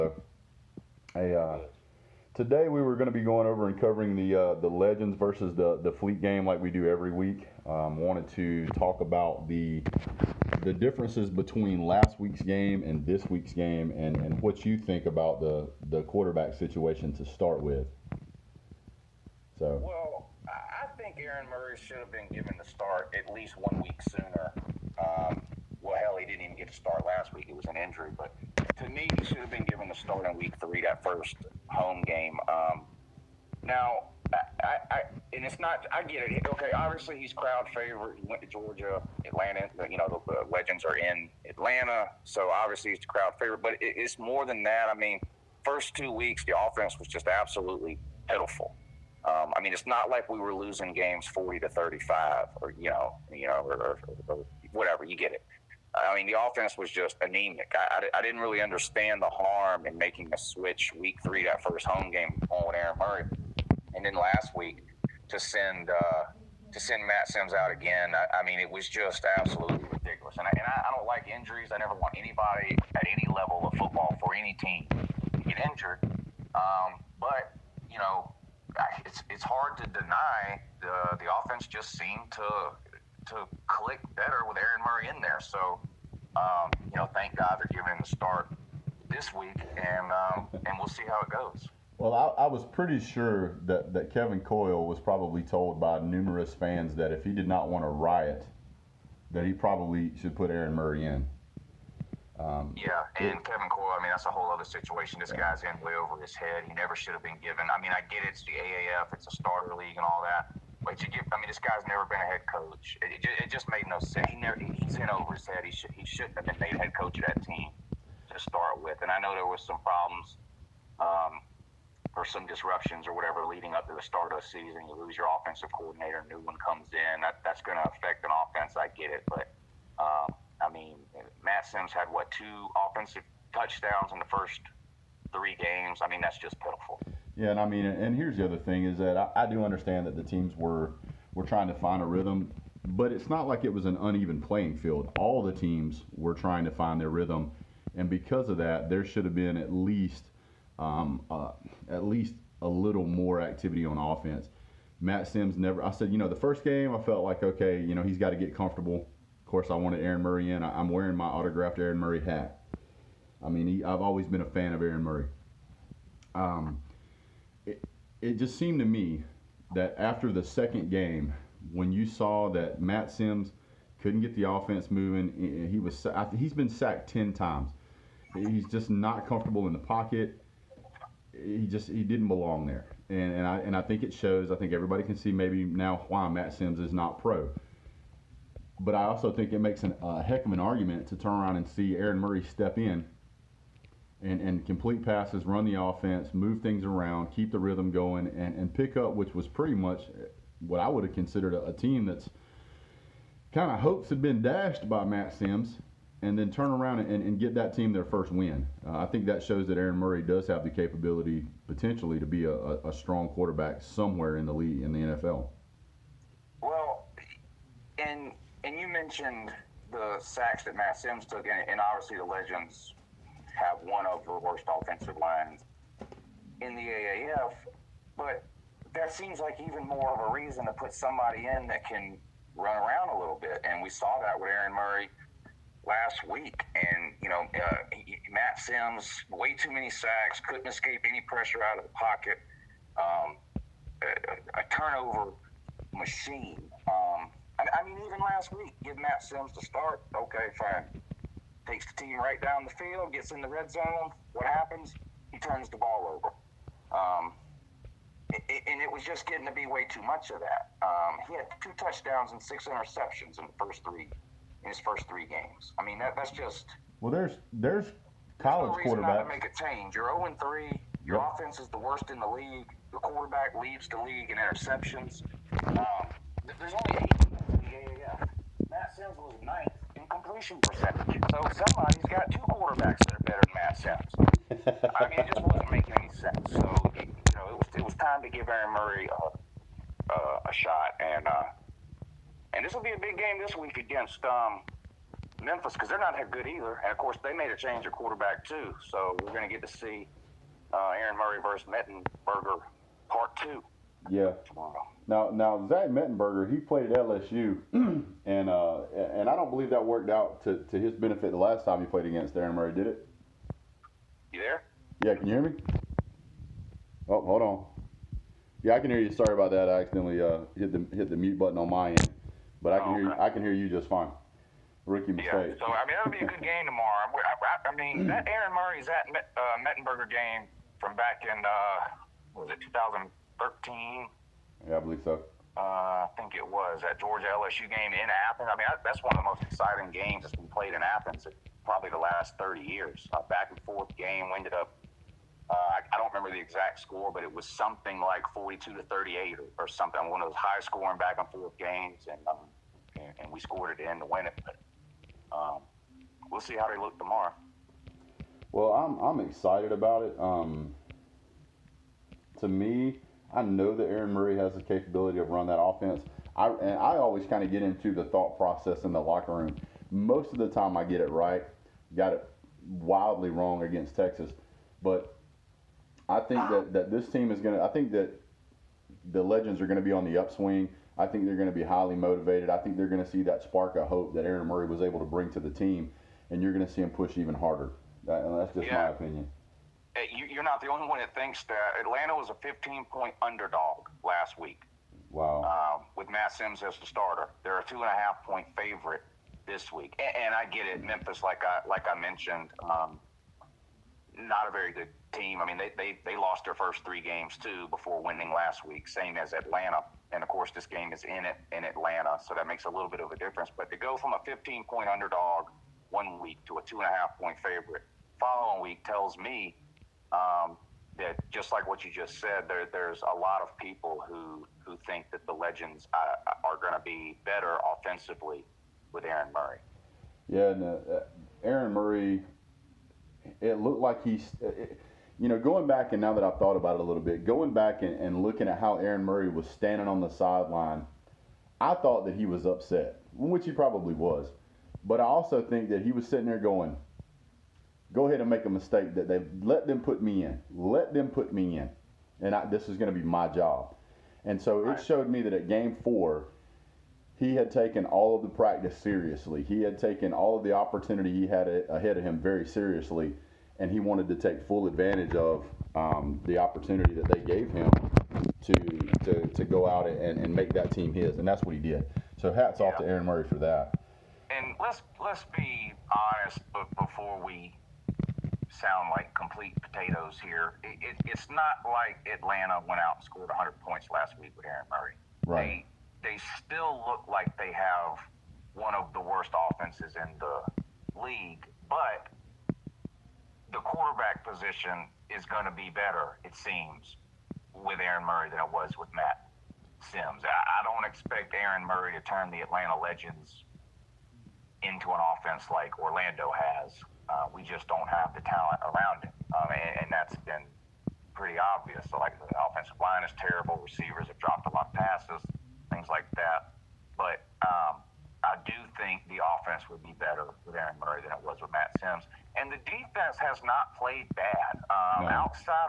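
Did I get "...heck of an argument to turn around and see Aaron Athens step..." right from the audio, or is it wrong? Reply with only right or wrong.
wrong.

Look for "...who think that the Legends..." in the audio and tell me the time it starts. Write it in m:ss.
7:04.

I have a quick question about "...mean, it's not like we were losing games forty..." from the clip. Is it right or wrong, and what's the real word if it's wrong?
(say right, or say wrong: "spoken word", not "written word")
right.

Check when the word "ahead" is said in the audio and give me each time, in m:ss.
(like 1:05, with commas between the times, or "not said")
7:28, 7:41.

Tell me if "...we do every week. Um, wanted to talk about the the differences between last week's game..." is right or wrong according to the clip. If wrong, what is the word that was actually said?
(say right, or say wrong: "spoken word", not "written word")
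right.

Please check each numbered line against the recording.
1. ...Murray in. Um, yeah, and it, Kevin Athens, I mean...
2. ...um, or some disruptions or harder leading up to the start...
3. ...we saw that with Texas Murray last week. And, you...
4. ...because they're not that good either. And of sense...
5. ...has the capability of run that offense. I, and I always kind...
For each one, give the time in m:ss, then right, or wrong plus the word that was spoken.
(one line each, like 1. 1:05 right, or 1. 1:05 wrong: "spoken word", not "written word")
1. 1:40 wrong: "Coyle", not "Athens"
2. 2:00 wrong: "whatever", not "harder"
3. 3:53 wrong: "Aaron", not "Texas"
4. 4:55 wrong: "course", not "sense"
5. 6:04 right.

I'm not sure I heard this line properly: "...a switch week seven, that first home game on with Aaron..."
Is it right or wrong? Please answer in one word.
wrong.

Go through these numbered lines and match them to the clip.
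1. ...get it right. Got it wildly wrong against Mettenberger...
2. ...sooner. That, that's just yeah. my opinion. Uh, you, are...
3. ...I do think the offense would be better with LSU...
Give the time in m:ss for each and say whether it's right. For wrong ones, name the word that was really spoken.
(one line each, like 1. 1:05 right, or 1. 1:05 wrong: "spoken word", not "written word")
1. 6:10 wrong: "Texas", not "Mettenberger"
2. 6:27 wrong: "harder", not "sooner"
3. 8:38 wrong: "Aaron", not "LSU".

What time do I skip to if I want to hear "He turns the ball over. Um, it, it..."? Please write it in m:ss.
4:15.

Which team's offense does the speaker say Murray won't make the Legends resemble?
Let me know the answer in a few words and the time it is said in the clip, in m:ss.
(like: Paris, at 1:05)
Orlando, at 8:25.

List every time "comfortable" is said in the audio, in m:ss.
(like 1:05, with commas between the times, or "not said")
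2:38, 2:59.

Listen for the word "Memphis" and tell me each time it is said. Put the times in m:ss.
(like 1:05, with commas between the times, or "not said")
4:55, 6:40.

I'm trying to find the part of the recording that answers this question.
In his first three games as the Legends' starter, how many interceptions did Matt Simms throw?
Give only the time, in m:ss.
4:22.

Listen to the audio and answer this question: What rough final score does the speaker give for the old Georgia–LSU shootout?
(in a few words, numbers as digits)
42 to 38.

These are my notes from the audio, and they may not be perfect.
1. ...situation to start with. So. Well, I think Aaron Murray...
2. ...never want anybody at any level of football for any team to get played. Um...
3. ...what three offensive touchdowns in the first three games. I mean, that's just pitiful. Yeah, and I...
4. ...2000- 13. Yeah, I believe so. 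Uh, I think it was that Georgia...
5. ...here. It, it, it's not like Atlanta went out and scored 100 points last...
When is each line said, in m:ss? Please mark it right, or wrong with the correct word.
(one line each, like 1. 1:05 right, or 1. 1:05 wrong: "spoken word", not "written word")
1. 0:16 right
2. 1:11 wrong: "injured", not "played"
3. 2:12 wrong: "two", not "three"
4. 5:32 right
5. 8:00 right.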